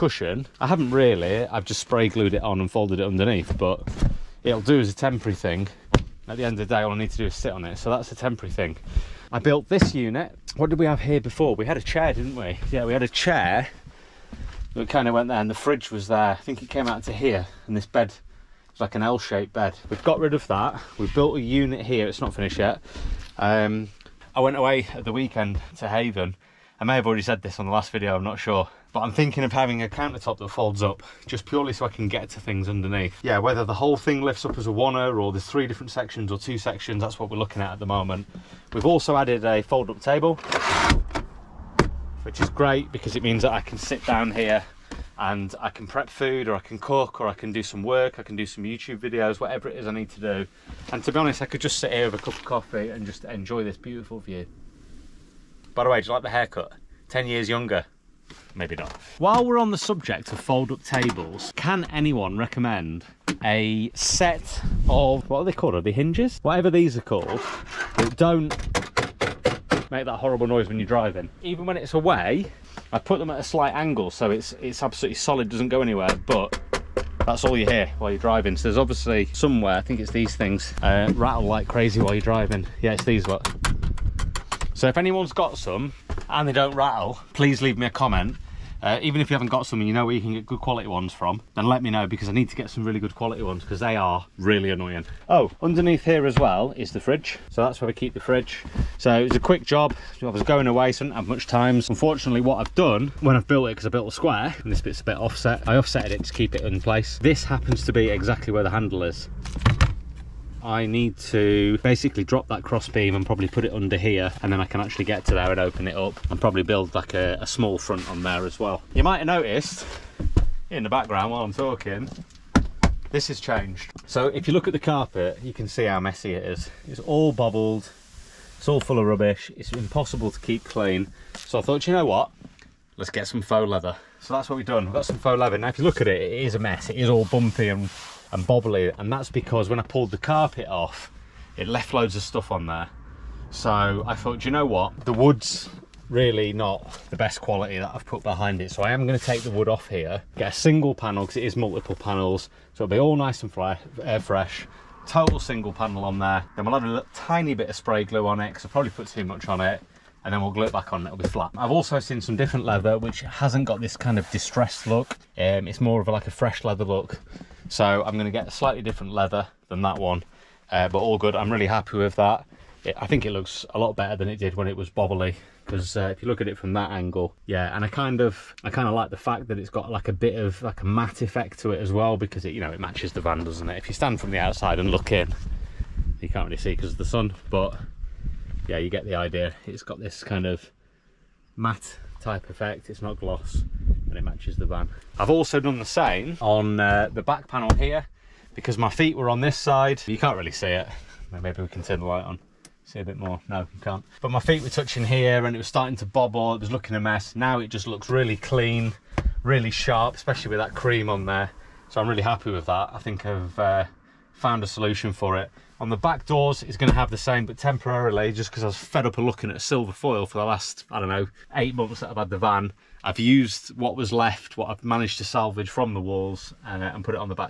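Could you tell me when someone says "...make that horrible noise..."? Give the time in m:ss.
1:09.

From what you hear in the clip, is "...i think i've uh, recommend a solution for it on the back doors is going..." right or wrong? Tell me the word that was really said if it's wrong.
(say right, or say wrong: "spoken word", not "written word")
wrong: "found", not "recommend".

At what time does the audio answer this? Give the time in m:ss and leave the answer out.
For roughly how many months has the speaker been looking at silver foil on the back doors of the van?
3:41.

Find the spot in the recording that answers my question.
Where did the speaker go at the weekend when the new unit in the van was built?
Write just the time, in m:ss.
0:25.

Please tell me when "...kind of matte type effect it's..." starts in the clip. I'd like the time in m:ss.
3:10.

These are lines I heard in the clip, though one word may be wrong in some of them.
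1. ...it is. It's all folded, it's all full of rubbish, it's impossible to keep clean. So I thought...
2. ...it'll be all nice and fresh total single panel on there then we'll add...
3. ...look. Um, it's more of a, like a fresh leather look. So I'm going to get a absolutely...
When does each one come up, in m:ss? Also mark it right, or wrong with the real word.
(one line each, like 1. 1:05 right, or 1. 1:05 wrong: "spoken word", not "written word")
1. 2:06 wrong: "bubbled", not "folded"
2. 2:32 right
3. 2:44 wrong: "slightly", not "absolutely".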